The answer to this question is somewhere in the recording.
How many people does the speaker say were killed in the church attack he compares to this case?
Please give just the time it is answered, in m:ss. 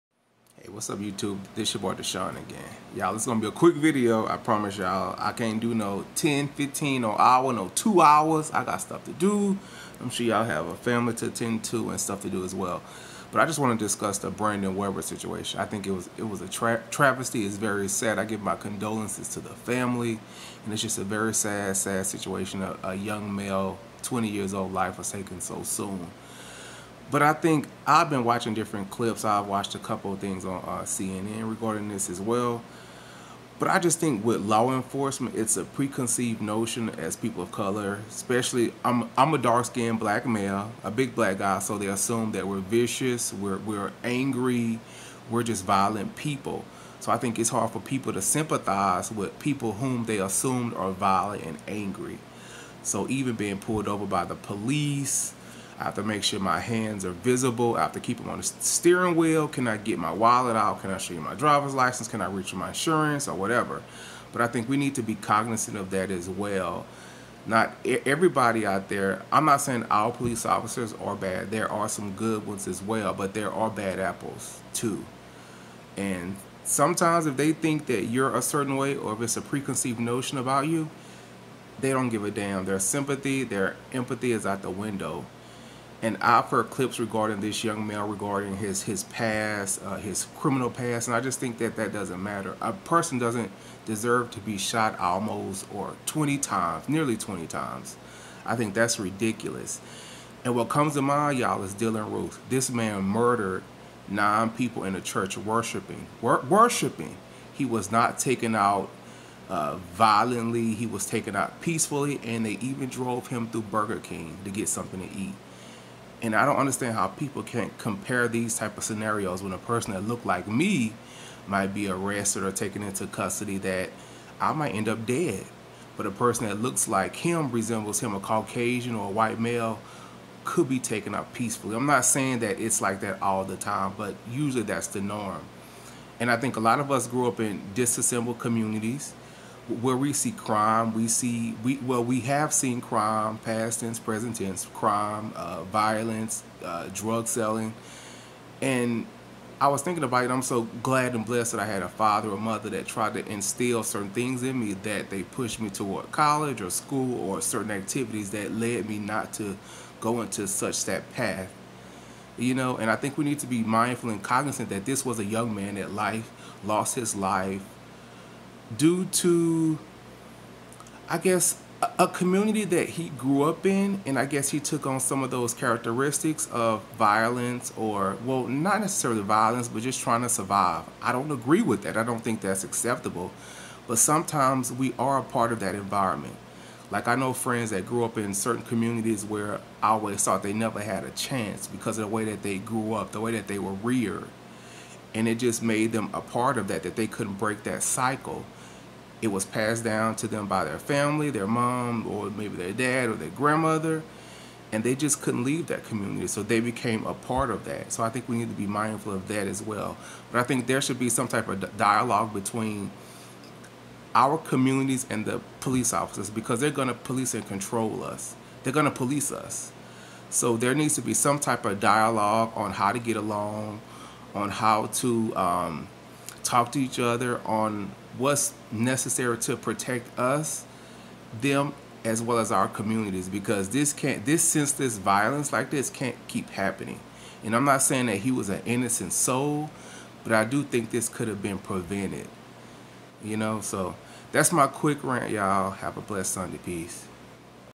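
1:44.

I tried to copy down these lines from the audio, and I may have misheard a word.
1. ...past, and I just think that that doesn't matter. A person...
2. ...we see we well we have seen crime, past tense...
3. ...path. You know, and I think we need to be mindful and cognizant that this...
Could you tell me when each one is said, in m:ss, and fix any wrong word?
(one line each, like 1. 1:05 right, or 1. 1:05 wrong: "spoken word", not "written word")
1. 1:30 right
2. 2:20 right
3. 2:41 right.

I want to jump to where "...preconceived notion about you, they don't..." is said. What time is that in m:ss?
1:19.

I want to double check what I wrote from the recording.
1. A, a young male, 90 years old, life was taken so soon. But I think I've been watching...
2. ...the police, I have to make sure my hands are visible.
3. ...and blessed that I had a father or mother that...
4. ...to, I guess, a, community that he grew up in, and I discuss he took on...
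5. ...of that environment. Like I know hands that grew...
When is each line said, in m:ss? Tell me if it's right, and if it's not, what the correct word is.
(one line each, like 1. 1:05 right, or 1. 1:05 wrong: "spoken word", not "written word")
1. 0:22 wrong: "20", not "90"
2. 0:54 right
3. 2:31 right
4. 2:49 wrong: "guess", not "discuss"
5. 3:05 wrong: "friends", not "hands".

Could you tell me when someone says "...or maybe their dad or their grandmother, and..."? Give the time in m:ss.
3:22.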